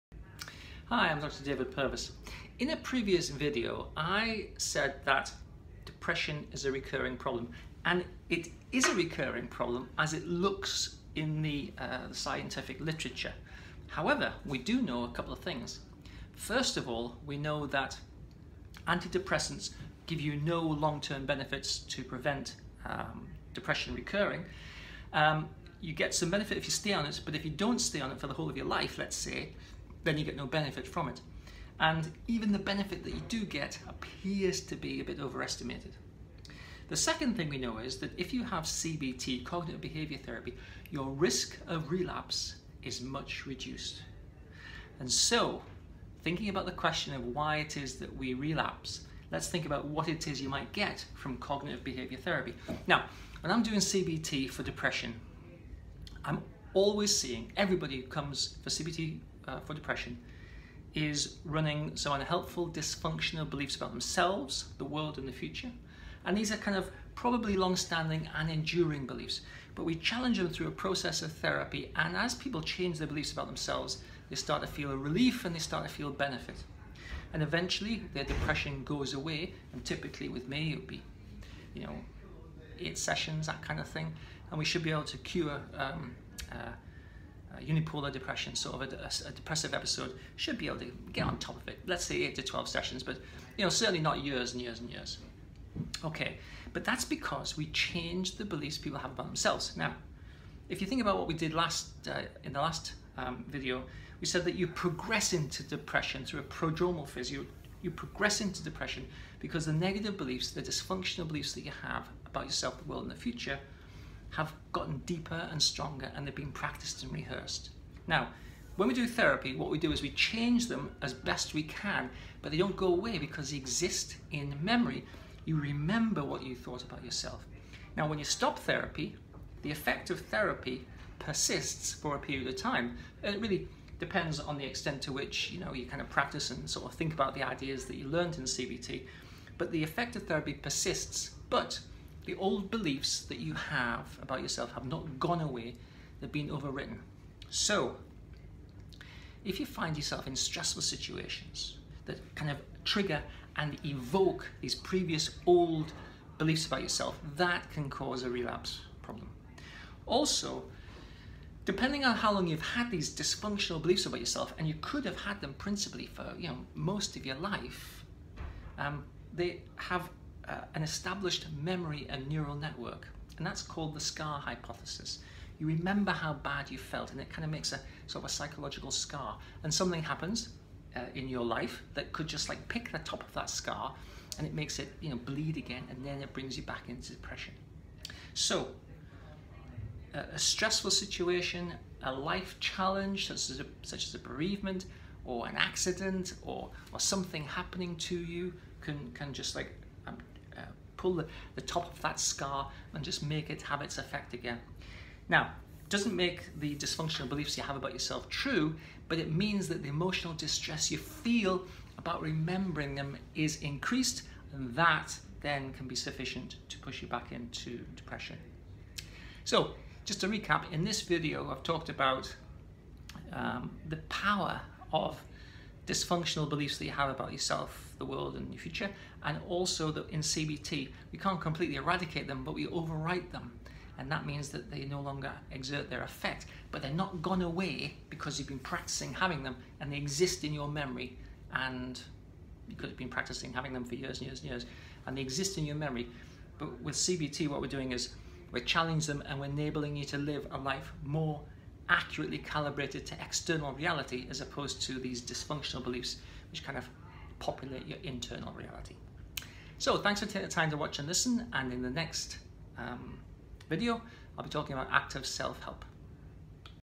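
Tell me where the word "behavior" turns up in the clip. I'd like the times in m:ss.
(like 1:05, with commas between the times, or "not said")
0:39, 0:51.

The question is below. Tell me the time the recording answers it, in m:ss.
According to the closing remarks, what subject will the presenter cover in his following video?
4:24.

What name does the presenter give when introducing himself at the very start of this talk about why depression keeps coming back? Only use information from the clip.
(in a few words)
David Purves.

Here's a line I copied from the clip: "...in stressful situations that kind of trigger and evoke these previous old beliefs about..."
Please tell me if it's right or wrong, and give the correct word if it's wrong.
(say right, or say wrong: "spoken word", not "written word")
right.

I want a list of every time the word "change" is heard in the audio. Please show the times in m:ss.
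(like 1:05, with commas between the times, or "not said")
1:12, 1:37, 2:00.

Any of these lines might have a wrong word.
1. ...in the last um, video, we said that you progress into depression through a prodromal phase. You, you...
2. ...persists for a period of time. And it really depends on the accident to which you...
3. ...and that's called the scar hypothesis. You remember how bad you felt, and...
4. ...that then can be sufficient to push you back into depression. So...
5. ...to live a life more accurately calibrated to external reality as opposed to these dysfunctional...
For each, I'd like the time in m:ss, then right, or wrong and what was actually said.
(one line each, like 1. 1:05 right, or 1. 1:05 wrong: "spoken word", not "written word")
1. 1:42 right
2. 2:11 wrong: "extent", not "accident"
3. 2:53 right
4. 3:34 right
5. 4:10 right.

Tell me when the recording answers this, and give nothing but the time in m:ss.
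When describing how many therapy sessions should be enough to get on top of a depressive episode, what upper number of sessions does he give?
1:32.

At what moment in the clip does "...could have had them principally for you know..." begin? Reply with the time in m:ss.
2:44.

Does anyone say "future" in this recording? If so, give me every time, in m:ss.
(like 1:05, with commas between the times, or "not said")
1:05, 1:53, 3:48.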